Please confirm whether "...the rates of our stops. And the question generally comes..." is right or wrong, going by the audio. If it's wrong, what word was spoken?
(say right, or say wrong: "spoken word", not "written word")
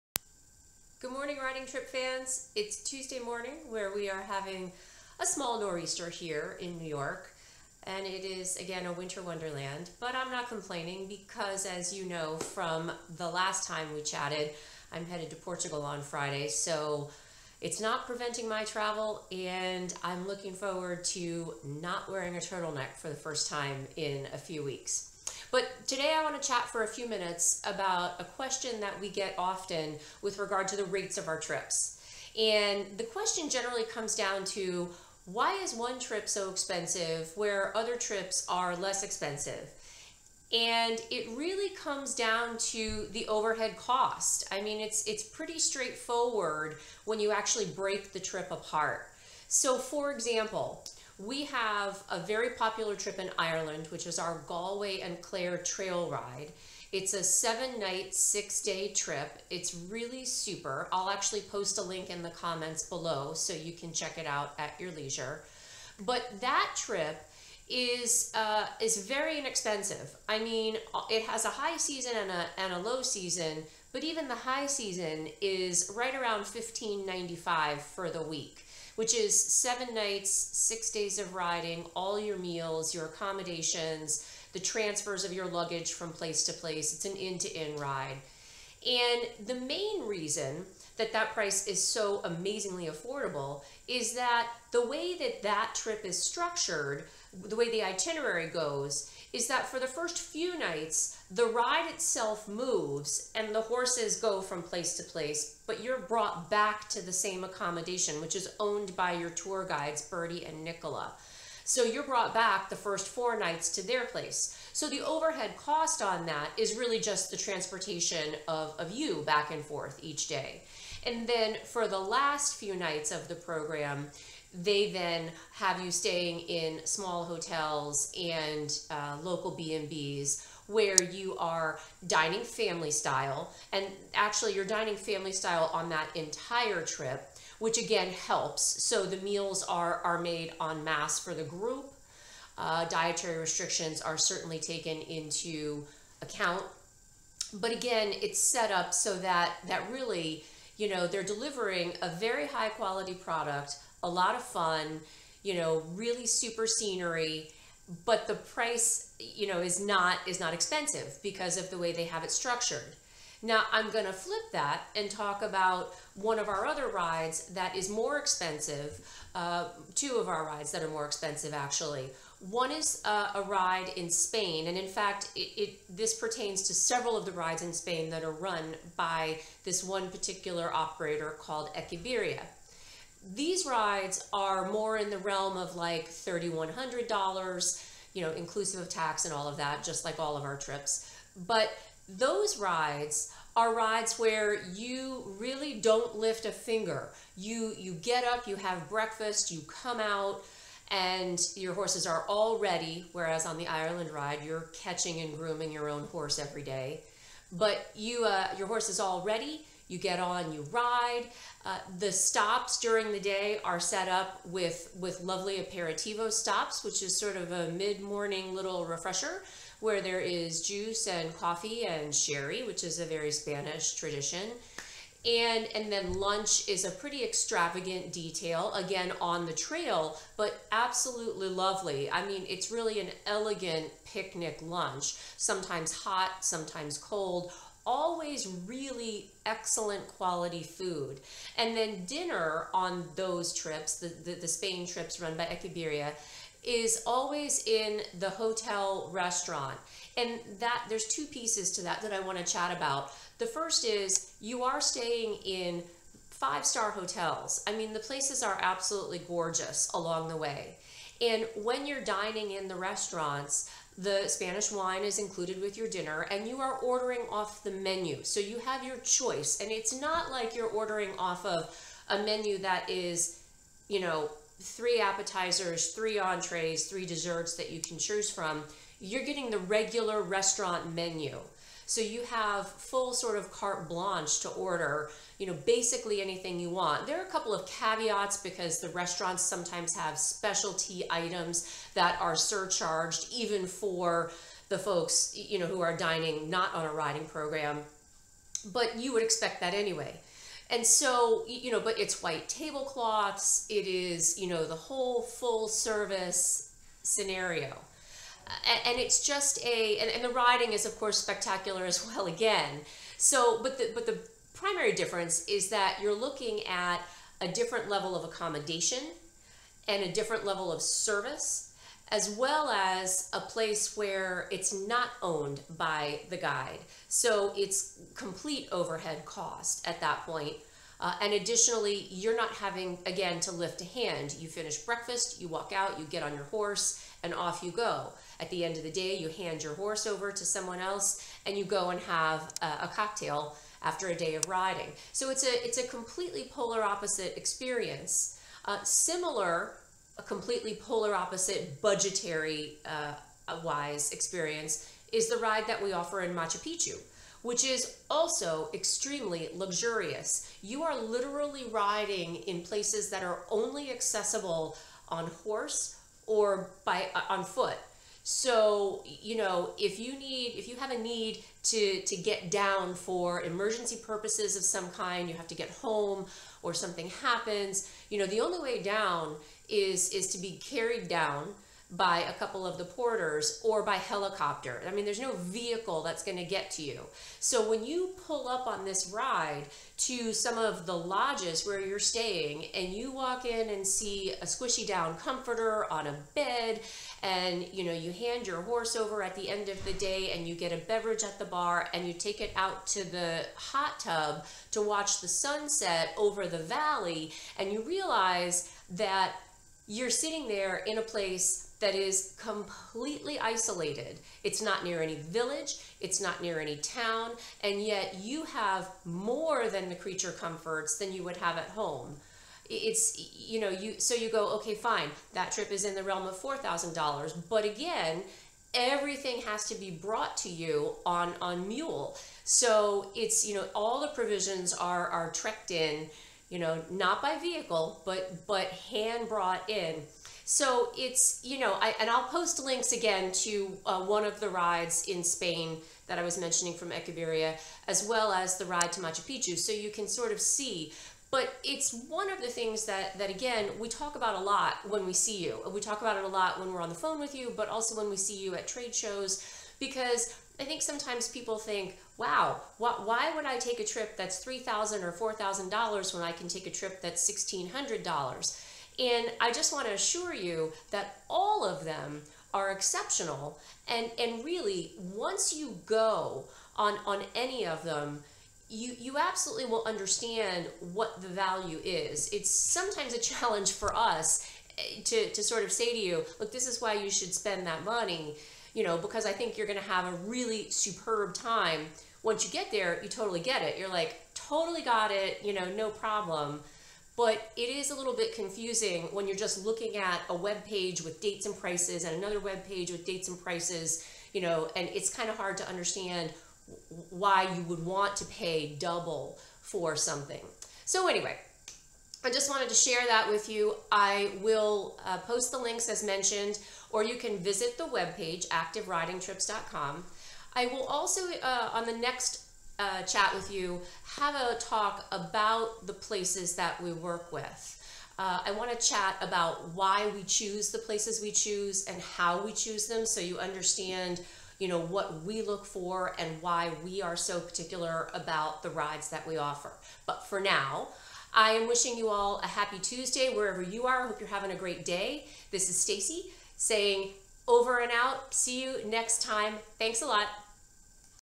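wrong: "trips", not "stops".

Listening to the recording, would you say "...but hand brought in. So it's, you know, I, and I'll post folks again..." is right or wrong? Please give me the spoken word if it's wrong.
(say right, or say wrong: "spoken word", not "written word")
wrong: "links", not "folks".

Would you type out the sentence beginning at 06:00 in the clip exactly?
You are literally riding in places that are only accessible on horse or by uh, on foot.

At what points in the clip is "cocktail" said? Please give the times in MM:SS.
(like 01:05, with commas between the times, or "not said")
05:42.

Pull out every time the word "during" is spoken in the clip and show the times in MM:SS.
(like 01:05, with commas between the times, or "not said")
03:32.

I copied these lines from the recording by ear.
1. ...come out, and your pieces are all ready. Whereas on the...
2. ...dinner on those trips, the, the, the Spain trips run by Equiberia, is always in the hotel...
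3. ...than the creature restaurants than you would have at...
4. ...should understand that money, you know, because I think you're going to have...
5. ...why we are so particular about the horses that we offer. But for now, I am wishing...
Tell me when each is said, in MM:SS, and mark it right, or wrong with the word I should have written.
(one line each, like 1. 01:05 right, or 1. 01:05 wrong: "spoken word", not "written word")
1. 03:19 wrong: "horses", not "pieces"
2. 04:02 right
3. 06:59 wrong: "comforts", not "restaurants"
4. 08:07 wrong: "spend", not "understand"
5. 08:56 wrong: "rides", not "horses".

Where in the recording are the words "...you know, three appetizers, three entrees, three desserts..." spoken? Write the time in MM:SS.
04:33.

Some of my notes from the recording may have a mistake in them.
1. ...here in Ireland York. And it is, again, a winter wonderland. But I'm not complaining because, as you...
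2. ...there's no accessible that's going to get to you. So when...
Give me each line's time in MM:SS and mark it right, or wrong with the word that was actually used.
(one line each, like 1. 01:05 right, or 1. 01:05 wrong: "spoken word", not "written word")
1. 00:06 wrong: "New", not "Ireland"
2. 06:25 wrong: "vehicle", not "accessible".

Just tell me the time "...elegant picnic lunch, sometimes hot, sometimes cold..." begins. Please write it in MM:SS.
03:53.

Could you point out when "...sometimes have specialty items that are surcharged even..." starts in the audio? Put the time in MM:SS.
04:49.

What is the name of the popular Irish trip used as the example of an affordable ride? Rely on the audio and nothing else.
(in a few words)
Galway and Clare Trail Ride.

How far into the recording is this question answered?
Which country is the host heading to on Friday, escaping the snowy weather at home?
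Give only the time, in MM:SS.
00:15.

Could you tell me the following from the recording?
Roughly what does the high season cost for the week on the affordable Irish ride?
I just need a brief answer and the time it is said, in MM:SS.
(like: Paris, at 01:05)
1595, at 01:16.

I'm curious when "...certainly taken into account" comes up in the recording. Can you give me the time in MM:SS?
02:24.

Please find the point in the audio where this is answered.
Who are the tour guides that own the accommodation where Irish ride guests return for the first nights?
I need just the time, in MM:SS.
01:50.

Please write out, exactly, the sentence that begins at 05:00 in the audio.
And so, you know, but it's white tablecloths, it is, you know, the whole full service scenario.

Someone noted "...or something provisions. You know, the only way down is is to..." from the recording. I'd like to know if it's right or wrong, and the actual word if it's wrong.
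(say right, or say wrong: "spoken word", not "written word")
wrong: "happens", not "provisions".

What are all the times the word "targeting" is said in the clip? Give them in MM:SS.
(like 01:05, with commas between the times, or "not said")
not said.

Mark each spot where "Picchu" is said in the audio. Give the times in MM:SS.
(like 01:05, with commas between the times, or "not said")
05:56, 07:29.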